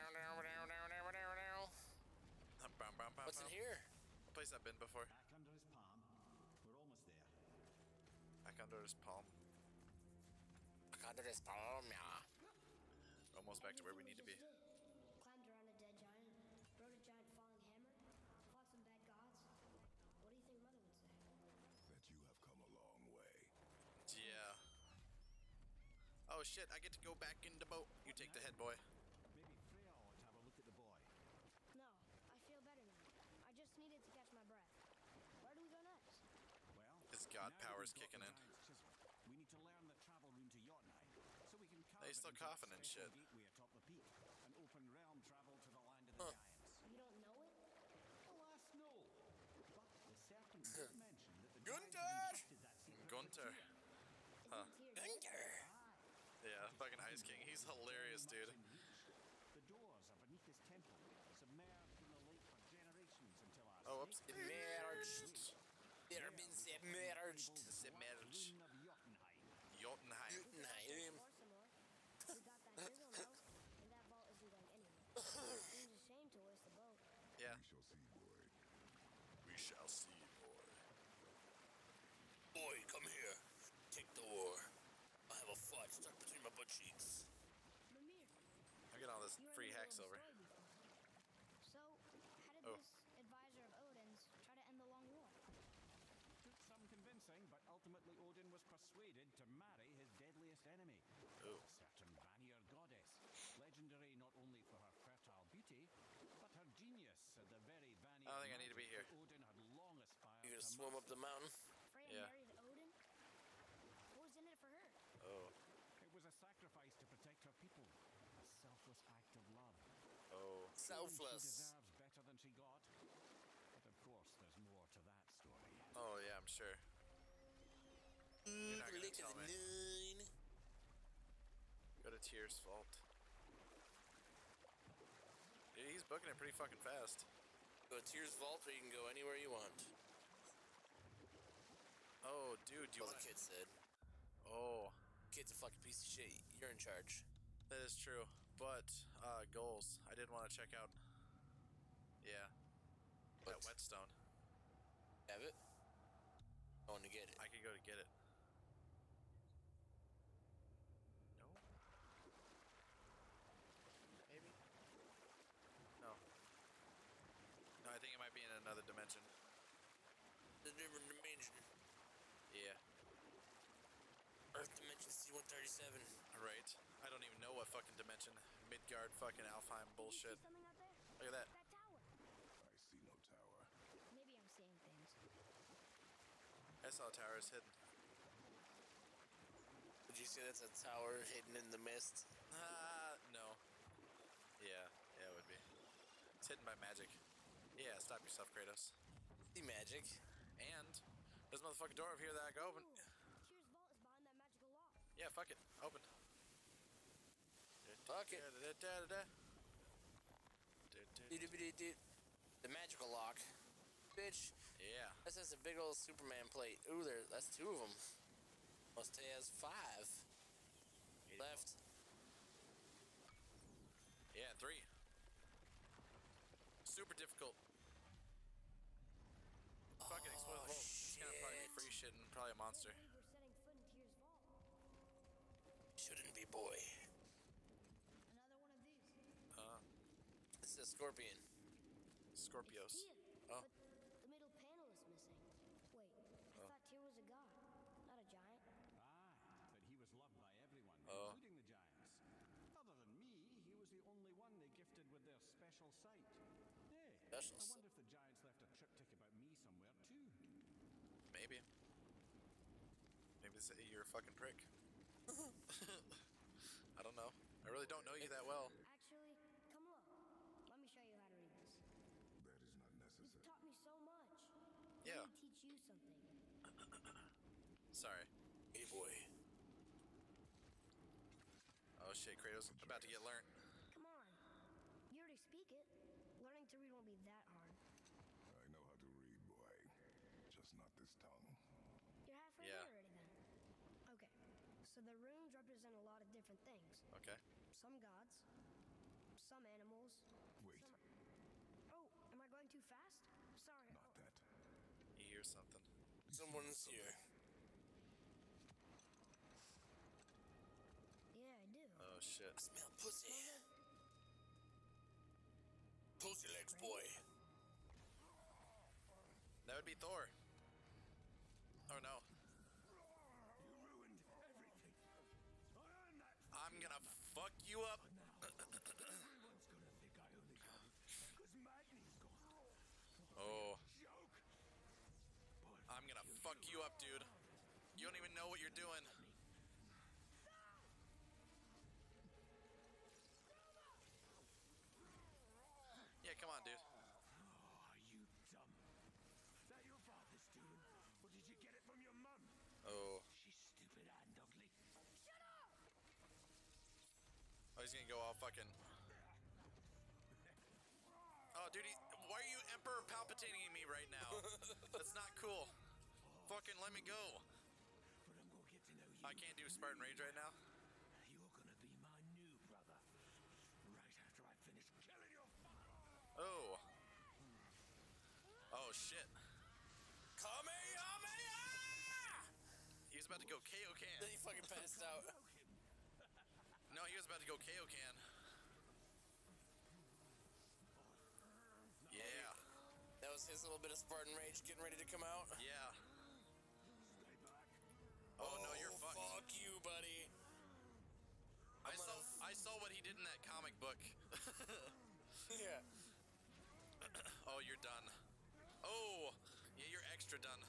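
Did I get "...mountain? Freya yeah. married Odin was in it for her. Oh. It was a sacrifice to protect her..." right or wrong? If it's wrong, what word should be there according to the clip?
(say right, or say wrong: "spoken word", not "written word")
right.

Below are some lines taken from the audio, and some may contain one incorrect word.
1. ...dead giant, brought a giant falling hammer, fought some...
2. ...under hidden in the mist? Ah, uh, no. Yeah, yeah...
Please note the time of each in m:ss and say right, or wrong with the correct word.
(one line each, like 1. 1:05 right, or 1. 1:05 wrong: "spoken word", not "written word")
1. 0:15 right
2. 3:10 wrong: "tower", not "under".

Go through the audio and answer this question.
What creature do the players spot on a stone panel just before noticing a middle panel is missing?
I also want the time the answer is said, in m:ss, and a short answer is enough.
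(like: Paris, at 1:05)
A scorpion, at 4:00.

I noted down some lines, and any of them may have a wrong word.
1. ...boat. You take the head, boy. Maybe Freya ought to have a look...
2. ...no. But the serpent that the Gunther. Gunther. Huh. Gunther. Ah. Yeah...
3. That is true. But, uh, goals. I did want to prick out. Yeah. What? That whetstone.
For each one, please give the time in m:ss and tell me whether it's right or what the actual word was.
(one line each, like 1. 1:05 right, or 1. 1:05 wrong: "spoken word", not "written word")
1. 0:27 right
2. 0:48 right
3. 2:27 wrong: "check", not "prick".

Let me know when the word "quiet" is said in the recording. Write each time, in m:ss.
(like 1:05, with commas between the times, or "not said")
not said.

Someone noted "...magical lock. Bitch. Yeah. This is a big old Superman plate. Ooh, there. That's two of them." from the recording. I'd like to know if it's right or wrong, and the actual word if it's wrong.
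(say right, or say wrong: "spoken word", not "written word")
right.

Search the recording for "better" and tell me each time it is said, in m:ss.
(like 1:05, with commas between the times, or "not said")
0:32, 2:01.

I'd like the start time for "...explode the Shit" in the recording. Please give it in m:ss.
3:50.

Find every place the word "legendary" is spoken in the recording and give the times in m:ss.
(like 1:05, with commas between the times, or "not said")
1:43.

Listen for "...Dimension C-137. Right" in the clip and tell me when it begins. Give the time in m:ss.
2:54.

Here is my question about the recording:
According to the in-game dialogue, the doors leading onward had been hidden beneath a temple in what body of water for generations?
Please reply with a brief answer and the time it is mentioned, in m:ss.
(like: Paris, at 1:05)
The lake, at 1:02.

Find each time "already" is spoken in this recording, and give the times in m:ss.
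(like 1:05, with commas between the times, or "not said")
4:45, 4:52.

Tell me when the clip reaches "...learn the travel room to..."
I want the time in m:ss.
0:39.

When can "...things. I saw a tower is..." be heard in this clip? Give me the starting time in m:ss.
3:04.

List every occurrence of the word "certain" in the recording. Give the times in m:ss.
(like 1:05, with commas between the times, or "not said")
1:41.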